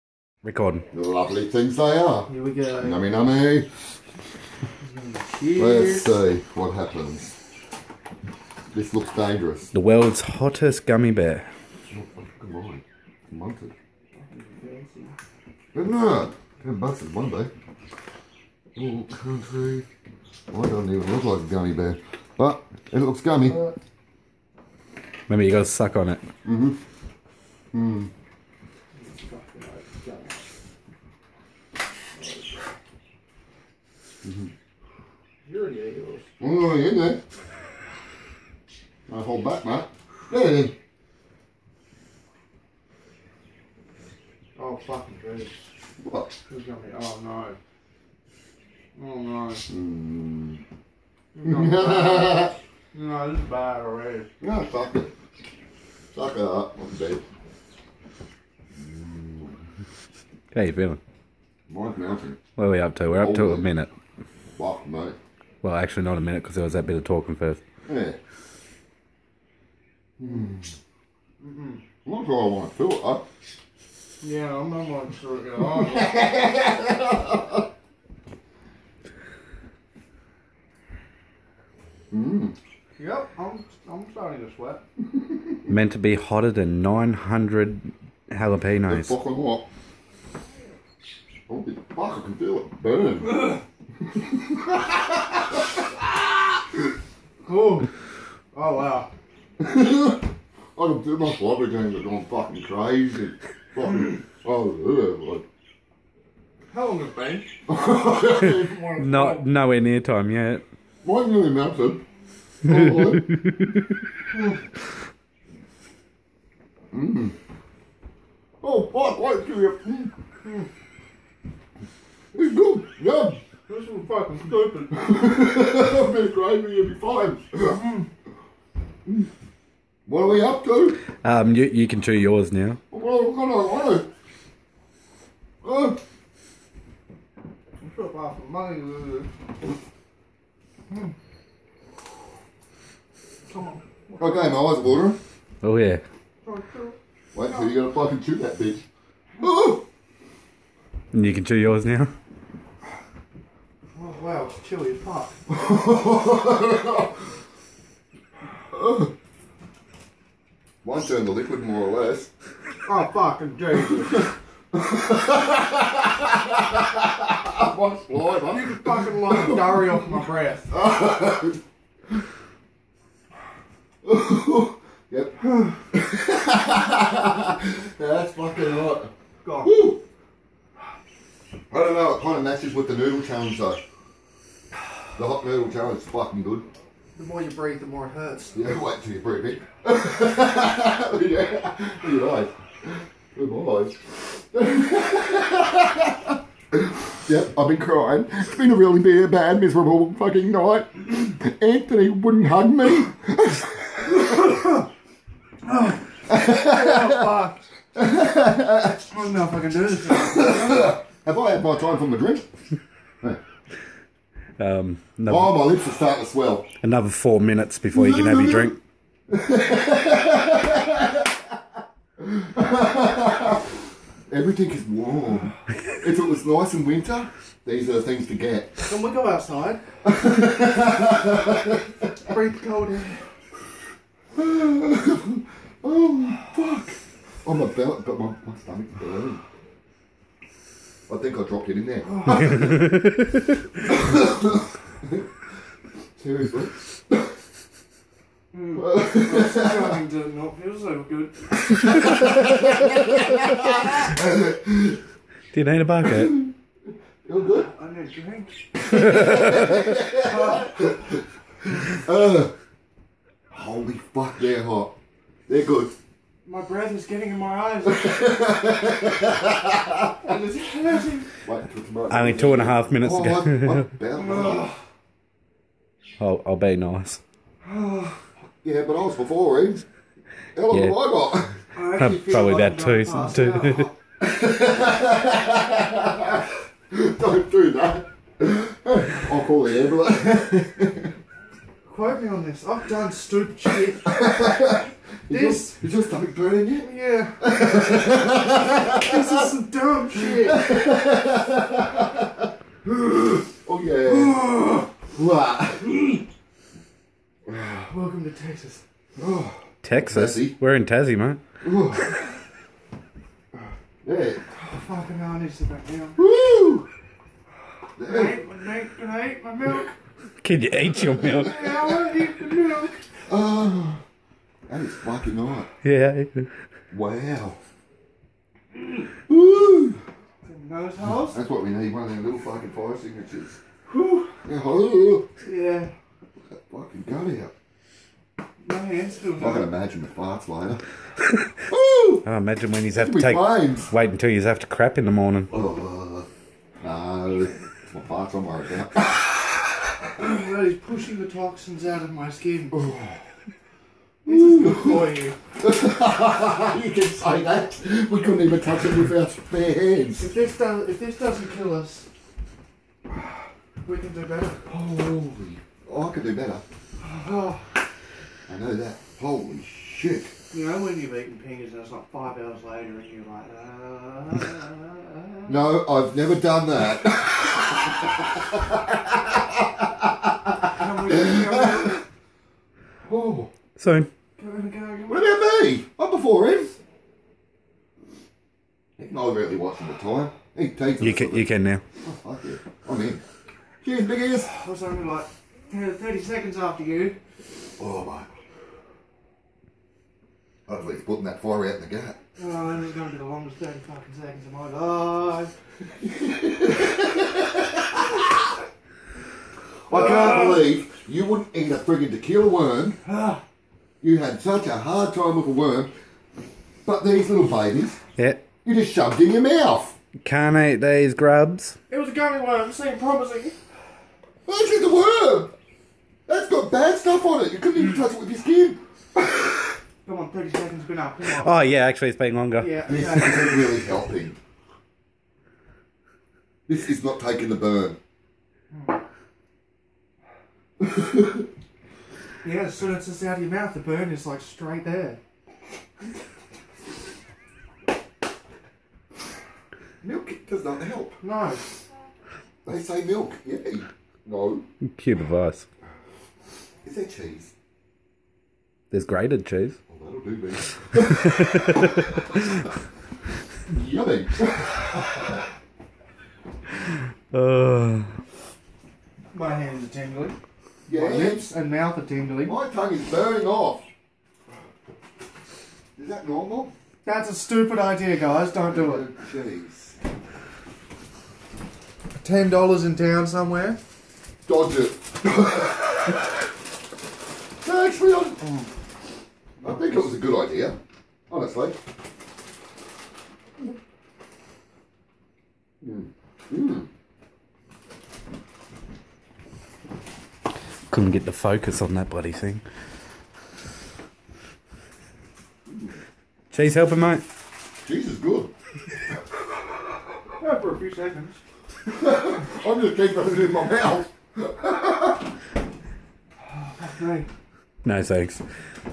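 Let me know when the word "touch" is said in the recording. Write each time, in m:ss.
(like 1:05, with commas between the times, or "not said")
5:58, 7:07.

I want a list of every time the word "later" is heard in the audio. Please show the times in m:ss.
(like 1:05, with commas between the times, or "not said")
5:40, 6:12.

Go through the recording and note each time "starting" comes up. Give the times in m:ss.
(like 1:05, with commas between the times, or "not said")
1:24, 3:35.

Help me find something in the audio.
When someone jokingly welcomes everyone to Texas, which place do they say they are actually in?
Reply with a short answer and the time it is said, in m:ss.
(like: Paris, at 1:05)
Tassie, at 5:10.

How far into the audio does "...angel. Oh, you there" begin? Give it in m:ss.
0:35.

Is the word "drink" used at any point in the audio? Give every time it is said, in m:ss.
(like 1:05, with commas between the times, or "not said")
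3:32, 3:38, 4:18.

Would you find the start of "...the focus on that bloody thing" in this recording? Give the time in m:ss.
8:21.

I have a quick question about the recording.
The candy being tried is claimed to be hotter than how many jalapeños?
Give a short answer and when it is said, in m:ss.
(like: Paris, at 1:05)
900, at 1:26.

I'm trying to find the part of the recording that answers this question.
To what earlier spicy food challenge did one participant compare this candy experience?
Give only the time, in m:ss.
3:05.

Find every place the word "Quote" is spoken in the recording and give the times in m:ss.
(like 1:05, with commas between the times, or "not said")
4:51.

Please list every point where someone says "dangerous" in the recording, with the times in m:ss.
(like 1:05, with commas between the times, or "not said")
0:09.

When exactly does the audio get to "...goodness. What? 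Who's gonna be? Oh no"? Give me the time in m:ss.
0:45.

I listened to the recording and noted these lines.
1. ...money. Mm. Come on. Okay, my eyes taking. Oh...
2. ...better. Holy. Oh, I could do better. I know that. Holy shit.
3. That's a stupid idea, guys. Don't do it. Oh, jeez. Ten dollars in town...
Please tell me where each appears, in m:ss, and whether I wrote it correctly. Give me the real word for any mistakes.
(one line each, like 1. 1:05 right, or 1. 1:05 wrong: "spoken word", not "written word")
1. 2:18 wrong: "watering", not "taking"
2. 6:04 right
3. 7:57 right.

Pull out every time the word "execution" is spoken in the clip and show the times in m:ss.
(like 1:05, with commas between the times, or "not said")
not said.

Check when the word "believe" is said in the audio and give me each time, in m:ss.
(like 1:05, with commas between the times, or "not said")
6:50.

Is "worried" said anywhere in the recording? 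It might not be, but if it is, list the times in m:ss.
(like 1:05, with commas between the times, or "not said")
5:48.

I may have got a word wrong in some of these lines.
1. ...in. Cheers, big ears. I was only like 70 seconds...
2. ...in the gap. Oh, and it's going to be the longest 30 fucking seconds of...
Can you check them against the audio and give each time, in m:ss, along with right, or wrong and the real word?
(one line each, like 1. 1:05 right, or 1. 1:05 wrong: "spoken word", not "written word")
1. 6:33 wrong: "30", not "70"
2. 6:41 right.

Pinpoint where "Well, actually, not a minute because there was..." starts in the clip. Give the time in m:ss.
1:05.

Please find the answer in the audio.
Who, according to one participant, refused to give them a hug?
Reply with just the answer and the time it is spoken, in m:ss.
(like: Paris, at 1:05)
Anthony, at 3:21.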